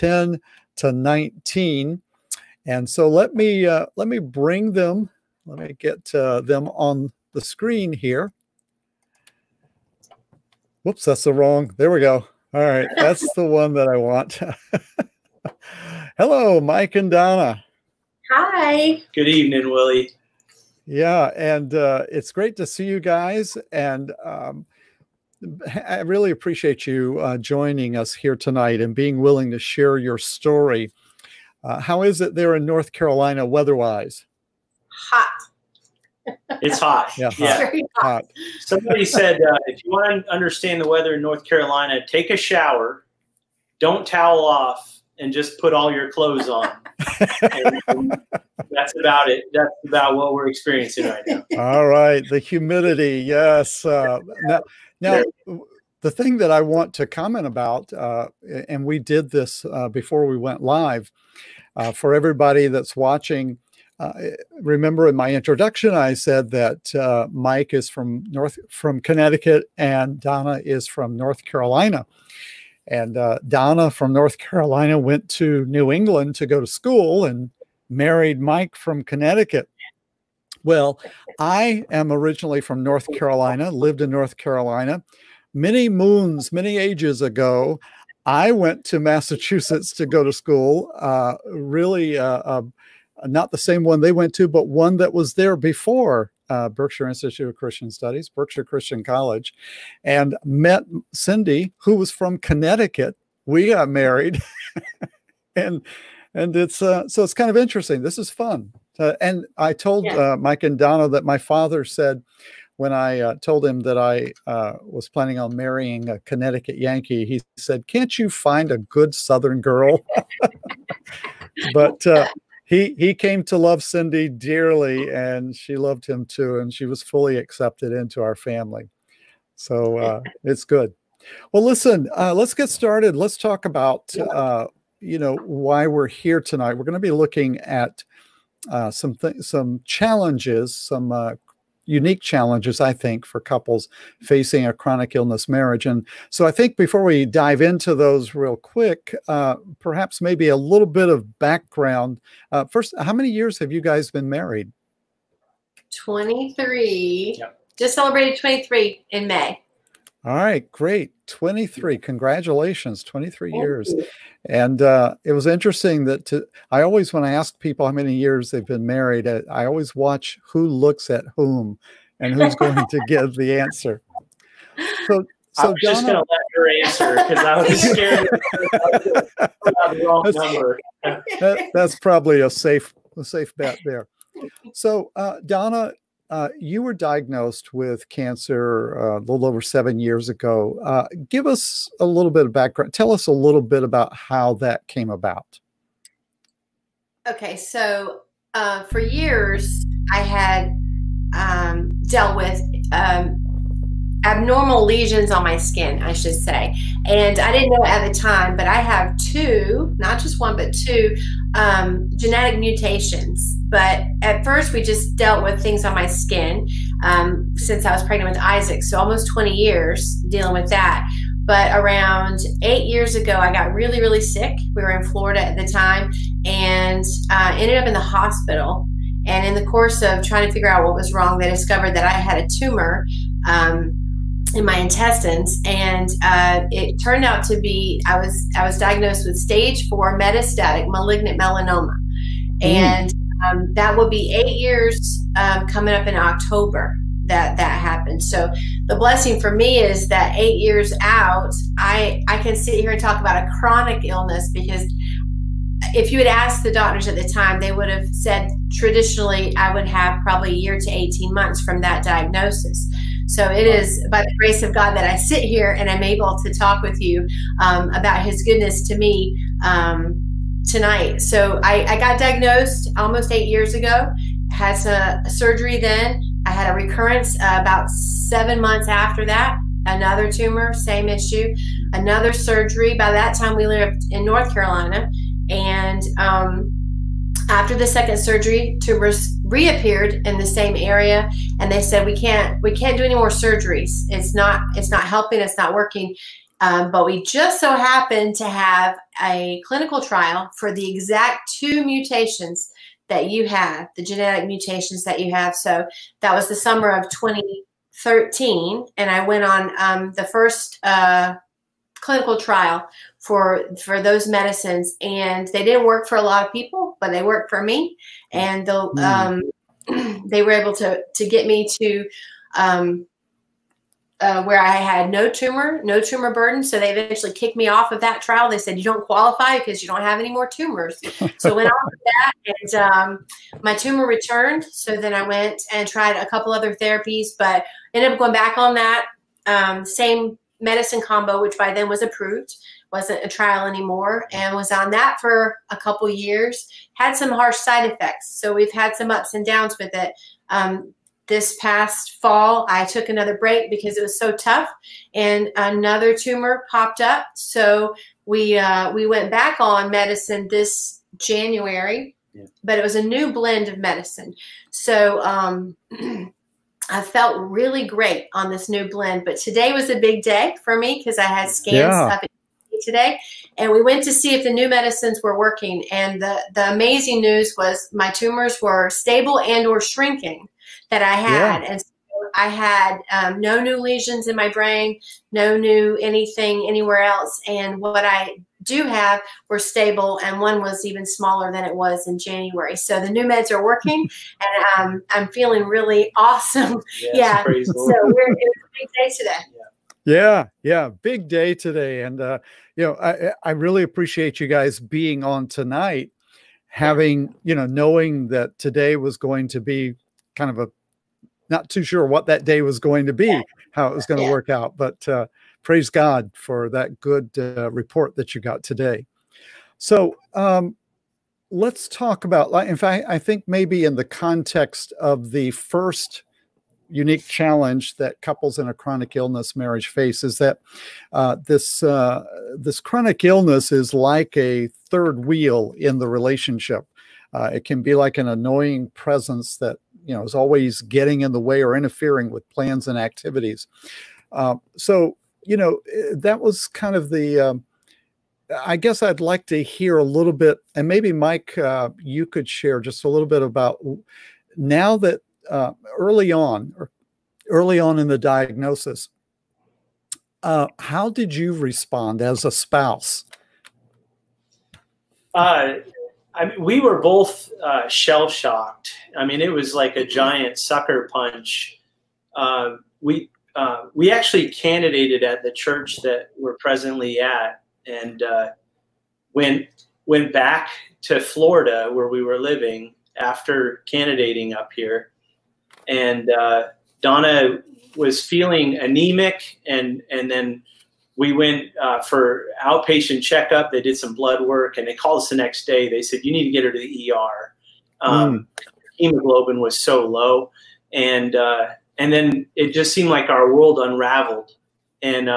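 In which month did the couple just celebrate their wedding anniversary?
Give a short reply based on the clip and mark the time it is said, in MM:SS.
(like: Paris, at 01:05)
May, at 02:39.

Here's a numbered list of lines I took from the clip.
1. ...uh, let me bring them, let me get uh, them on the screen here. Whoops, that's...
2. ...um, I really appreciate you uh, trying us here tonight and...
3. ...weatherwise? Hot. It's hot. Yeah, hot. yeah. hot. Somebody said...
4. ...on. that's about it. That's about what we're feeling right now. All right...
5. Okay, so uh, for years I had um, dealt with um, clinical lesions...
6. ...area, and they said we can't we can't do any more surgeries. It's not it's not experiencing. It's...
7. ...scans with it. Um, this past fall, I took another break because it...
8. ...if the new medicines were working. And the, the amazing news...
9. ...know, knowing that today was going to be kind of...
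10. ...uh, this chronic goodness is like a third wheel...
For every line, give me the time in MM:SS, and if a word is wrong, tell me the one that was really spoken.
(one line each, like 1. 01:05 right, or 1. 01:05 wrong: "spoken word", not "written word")
1. 00:03 right
2. 00:24 wrong: "joining", not "trying"
3. 00:33 right
4. 00:46 wrong: "experiencing", not "feeling"
5. 03:17 wrong: "abnormal", not "clinical"
6. 04:50 wrong: "helping", not "experiencing"
7. 05:49 wrong: "downs", not "scans"
8. 06:14 right
9. 06:47 right
10. 07:11 wrong: "illness", not "goodness".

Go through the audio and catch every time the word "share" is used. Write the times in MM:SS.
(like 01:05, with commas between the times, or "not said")
00:29, 07:32.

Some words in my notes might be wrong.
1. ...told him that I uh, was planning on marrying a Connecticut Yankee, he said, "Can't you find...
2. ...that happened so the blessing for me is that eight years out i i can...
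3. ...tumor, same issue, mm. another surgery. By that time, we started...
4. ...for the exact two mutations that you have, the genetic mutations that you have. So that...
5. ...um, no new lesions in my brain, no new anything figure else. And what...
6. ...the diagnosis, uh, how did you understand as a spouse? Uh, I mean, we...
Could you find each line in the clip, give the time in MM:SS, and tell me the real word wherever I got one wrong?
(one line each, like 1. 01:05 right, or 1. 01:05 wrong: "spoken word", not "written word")
1. 01:53 right
2. 04:07 right
3. 04:40 wrong: "lived", not "started"
4. 05:00 right
5. 06:23 wrong: "anywhere", not "figure"
6. 07:38 wrong: "respond", not "understand".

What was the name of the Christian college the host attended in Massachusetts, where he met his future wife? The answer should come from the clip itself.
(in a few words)
Berkshire Christian College.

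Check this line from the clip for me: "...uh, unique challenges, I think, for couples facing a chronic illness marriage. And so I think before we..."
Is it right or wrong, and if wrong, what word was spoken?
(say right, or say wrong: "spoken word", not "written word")
right.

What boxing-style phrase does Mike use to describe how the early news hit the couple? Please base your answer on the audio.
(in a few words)
a giant sucker punch.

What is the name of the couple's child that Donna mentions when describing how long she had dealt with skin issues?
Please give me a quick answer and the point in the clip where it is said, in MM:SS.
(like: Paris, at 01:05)
Isaac, at 03:38.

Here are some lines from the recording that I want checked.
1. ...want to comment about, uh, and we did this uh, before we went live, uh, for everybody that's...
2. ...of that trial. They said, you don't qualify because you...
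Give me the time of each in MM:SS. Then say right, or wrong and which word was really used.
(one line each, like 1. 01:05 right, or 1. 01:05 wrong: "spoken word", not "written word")
1. 00:56 right
2. 05:27 right.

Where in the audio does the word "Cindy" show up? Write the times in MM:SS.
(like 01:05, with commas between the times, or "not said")
01:41, 02:03.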